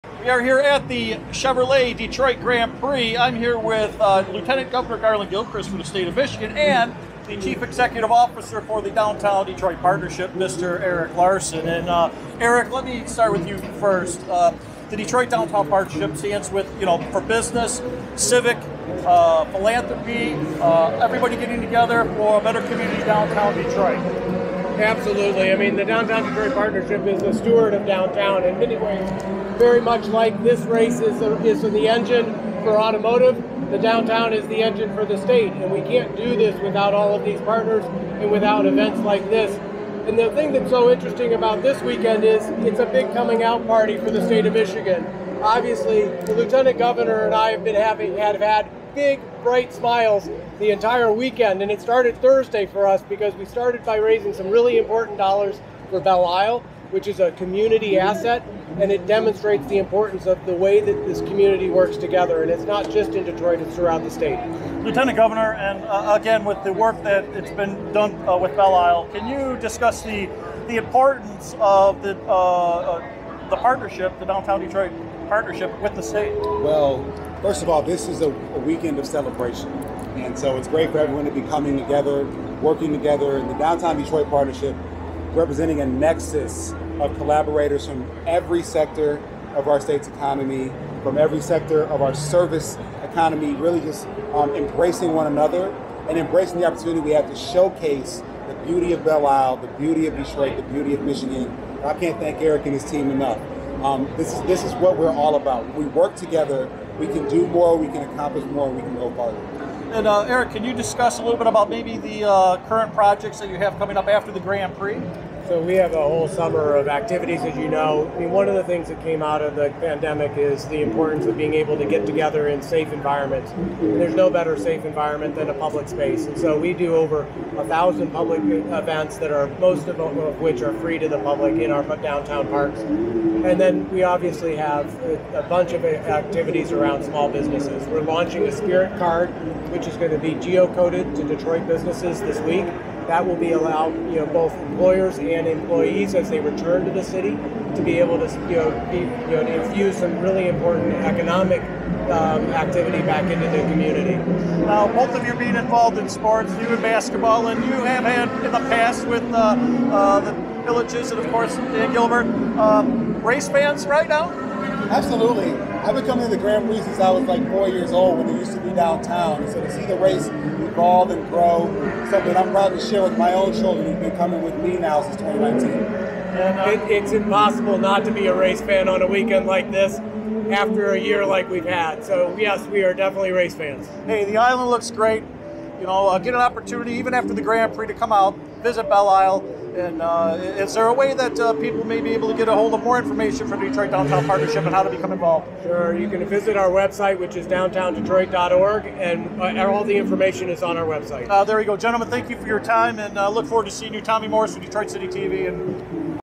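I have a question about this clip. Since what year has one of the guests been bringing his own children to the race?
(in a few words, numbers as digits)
2019.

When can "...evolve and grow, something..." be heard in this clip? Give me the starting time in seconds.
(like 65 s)
170 s.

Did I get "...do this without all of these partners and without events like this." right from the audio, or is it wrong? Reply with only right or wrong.
right.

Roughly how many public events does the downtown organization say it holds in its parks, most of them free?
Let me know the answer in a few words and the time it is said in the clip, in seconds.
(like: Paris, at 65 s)
Over 1,000, at 126 s.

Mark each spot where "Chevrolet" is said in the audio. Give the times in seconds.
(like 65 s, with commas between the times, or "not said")
1 s.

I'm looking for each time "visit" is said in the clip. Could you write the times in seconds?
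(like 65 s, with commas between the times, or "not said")
188 s, 196 s.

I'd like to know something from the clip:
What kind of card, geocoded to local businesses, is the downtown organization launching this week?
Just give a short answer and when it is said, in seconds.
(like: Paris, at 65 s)
Spirit card, at 138 s.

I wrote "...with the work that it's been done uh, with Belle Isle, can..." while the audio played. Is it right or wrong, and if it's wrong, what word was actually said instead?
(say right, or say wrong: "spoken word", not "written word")
right.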